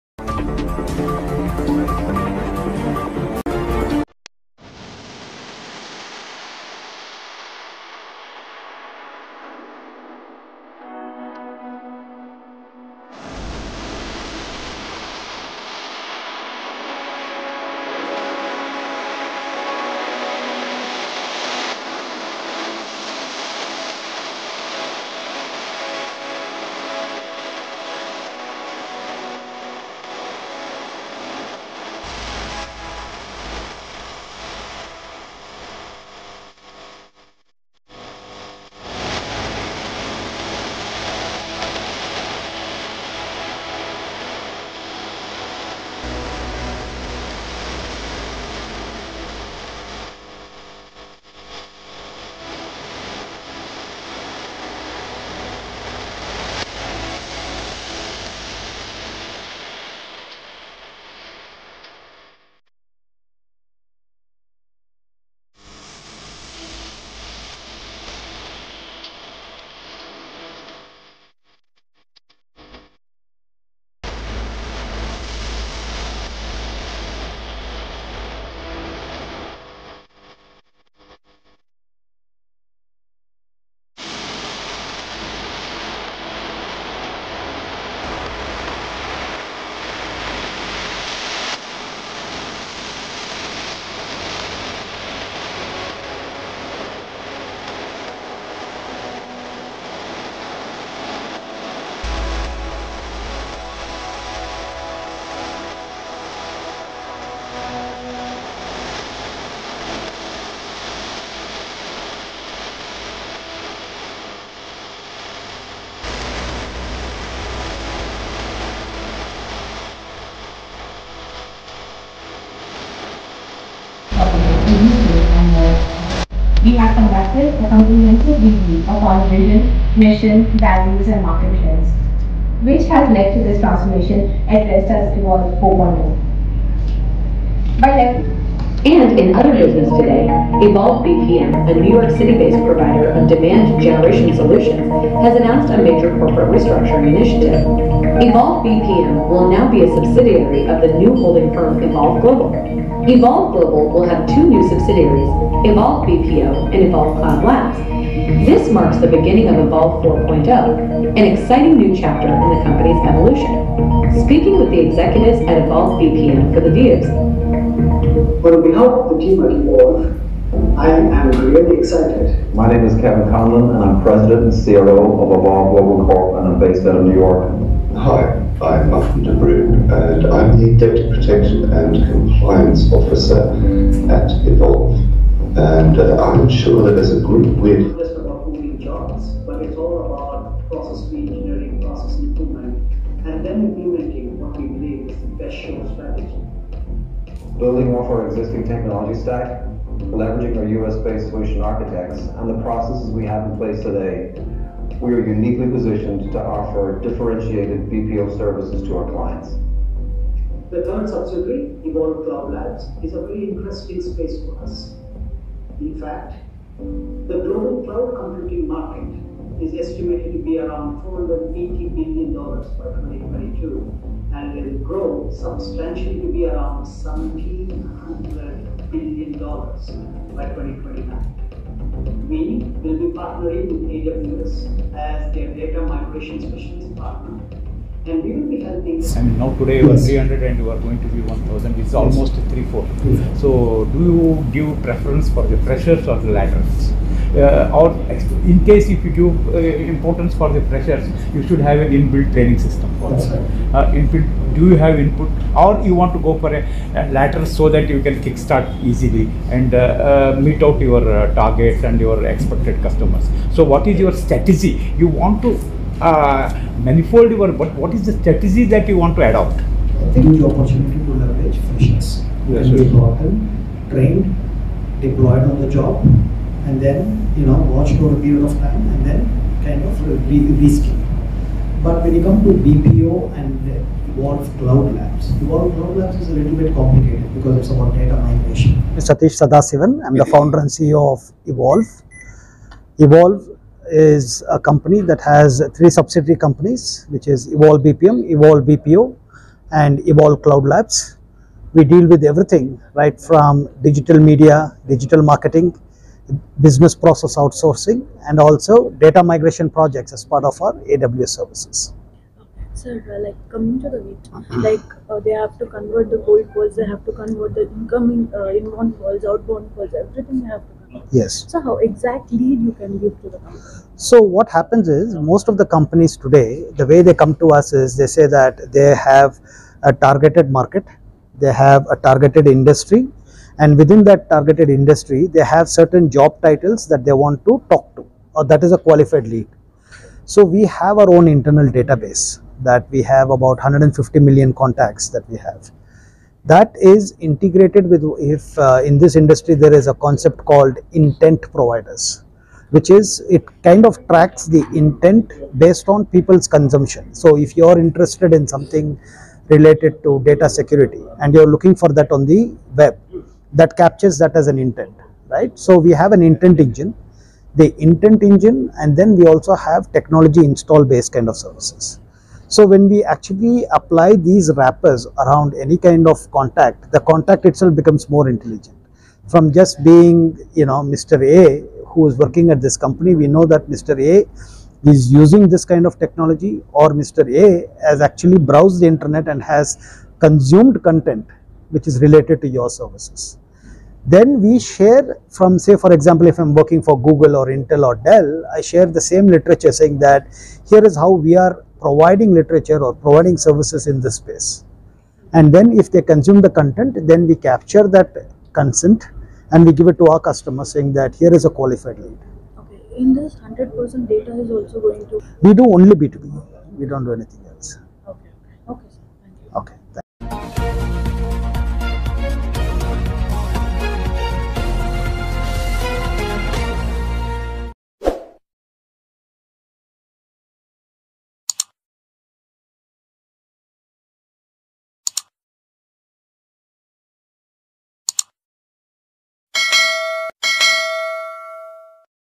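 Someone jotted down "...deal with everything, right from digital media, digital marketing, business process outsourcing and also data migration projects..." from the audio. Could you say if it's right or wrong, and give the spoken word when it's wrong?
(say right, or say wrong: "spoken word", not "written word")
right.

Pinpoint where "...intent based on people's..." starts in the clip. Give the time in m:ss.
5:54.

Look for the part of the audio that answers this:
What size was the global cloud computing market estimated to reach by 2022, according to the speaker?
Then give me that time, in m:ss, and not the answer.
3:41.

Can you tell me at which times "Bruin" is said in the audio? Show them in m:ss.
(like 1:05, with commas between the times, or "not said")
2:59.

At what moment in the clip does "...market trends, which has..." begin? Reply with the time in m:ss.
2:11.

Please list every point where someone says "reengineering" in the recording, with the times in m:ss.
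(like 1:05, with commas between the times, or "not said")
3:11.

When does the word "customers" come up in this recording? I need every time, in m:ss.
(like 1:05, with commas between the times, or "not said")
4:22, 6:50.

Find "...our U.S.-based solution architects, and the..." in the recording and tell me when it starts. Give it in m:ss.
3:20.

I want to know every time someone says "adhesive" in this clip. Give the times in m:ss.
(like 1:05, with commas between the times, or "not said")
not said.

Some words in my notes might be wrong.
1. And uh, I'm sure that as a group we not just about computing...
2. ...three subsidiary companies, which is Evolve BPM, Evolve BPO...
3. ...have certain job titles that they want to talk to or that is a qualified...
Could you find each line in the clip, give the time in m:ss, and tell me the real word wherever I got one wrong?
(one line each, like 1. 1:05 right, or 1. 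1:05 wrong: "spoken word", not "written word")
1. 3:05 wrong: "moving", not "computing"
2. 4:55 right
3. 5:35 right.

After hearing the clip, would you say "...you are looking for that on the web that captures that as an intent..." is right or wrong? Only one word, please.
right.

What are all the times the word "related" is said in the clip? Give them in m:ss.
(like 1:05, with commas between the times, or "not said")
5:59, 6:32.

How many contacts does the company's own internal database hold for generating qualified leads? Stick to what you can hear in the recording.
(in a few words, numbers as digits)
150 million.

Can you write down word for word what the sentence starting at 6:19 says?
From just being, you know, Mr.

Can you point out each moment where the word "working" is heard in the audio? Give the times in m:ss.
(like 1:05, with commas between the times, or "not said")
6:22, 6:36.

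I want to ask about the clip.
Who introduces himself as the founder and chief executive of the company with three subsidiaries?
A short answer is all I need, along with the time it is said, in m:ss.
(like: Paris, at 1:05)
Satish Sadasivan, at 4:49.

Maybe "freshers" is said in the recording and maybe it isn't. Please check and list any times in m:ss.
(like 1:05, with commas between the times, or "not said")
4:05, 4:10, 4:31.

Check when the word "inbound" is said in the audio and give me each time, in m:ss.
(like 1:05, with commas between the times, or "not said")
5:18.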